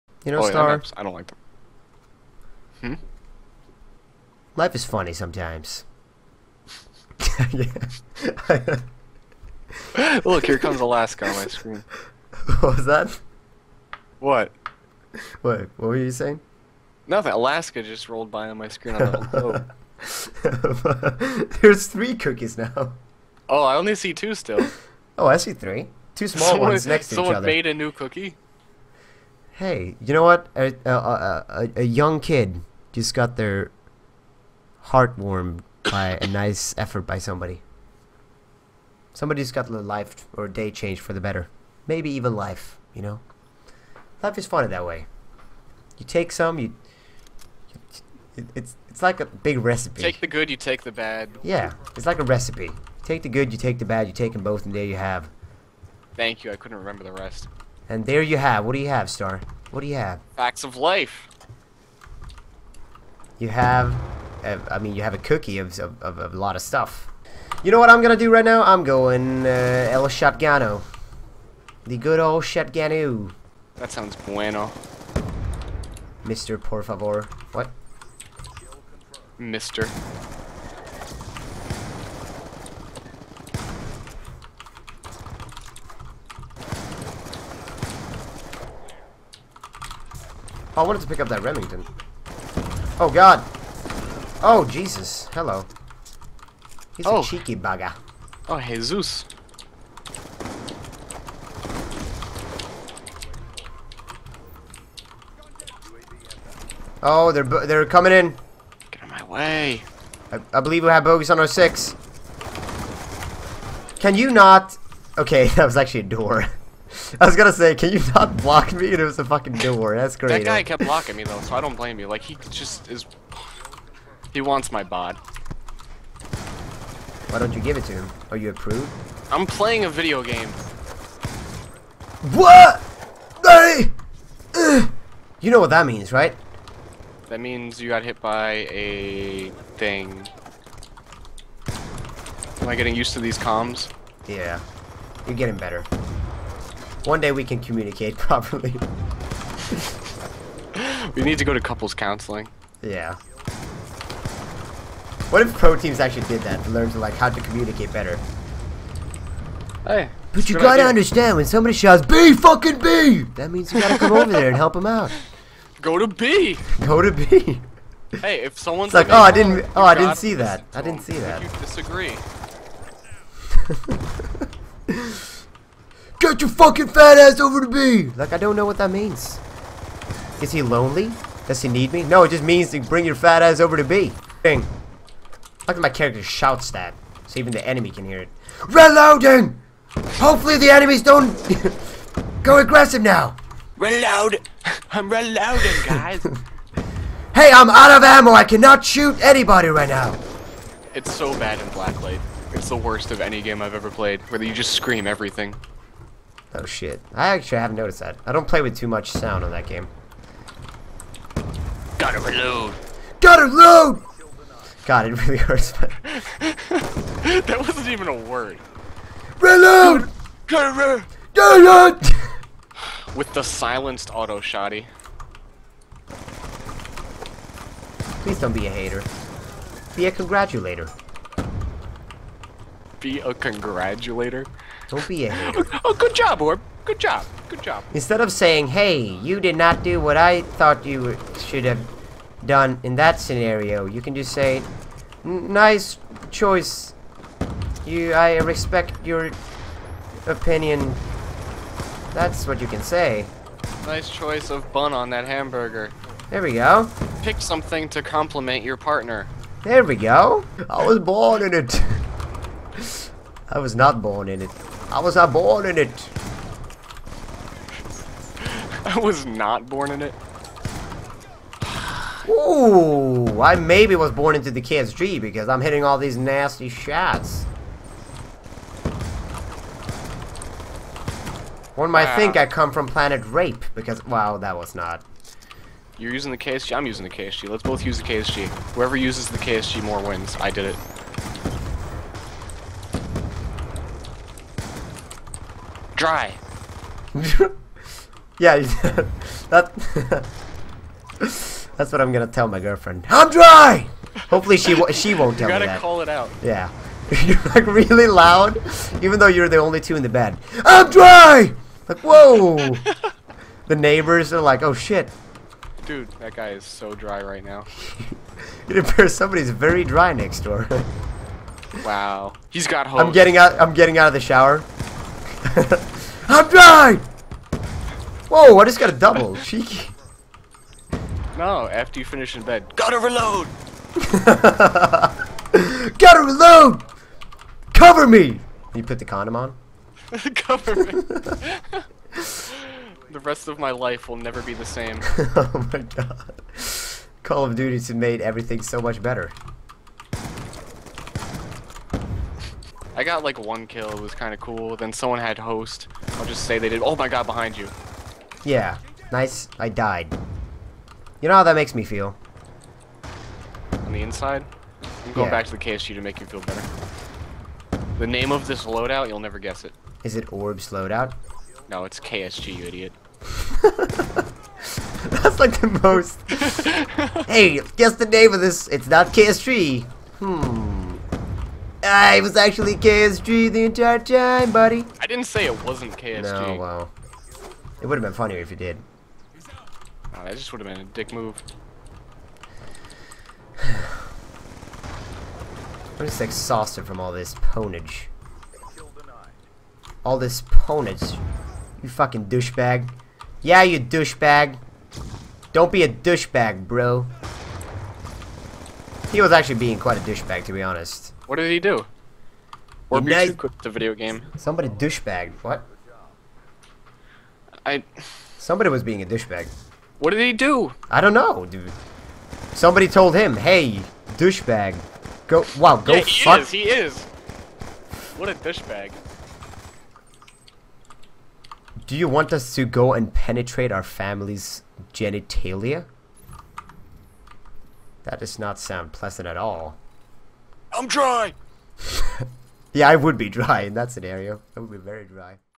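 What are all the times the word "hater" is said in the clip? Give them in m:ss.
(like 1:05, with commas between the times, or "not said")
3:48, 3:55.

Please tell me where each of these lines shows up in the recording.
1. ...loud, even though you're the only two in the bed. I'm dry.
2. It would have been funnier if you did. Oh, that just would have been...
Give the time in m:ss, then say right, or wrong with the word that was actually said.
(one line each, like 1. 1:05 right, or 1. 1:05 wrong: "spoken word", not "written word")
1. 5:08 right
2. 6:27 right.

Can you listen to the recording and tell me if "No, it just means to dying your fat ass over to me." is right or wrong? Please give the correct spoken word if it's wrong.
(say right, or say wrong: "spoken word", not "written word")
wrong: "bring", not "dying".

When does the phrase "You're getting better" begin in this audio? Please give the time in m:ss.
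2:25.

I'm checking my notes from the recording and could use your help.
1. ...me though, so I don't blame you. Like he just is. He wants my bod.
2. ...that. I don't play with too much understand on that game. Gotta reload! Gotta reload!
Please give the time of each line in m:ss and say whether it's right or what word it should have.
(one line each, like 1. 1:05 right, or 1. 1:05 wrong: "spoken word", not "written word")
1. 2:01 right
2. 3:27 wrong: "sound", not "understand".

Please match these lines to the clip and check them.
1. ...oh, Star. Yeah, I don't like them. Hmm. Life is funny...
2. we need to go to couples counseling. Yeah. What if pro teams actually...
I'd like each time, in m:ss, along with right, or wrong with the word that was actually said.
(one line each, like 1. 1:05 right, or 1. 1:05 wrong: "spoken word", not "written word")
1. 0:00 right
2. 2:31 right.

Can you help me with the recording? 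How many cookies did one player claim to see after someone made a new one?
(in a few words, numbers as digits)
3.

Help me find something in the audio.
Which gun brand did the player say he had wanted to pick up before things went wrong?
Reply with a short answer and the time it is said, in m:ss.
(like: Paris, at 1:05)
Remington, at 1:31.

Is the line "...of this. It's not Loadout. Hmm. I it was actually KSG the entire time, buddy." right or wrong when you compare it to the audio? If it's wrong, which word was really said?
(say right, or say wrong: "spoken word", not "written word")
wrong: "KSG", not "Loadout".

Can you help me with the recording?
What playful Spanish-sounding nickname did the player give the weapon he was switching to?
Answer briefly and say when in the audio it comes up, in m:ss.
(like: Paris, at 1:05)
El Shotgano, at 1:09.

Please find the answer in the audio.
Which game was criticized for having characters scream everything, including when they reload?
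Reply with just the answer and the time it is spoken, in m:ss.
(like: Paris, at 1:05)
Blacklight, at 3:21.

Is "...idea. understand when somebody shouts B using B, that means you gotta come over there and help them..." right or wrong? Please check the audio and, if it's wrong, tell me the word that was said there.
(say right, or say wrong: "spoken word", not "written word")
wrong: "fucking", not "using".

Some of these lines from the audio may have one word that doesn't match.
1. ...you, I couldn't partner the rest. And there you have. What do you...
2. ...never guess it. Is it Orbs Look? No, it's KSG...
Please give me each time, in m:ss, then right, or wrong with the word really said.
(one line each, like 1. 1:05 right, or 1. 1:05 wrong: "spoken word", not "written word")
1. 0:56 wrong: "remember", not "partner"
2. 6:09 wrong: "Loadout", not "Look".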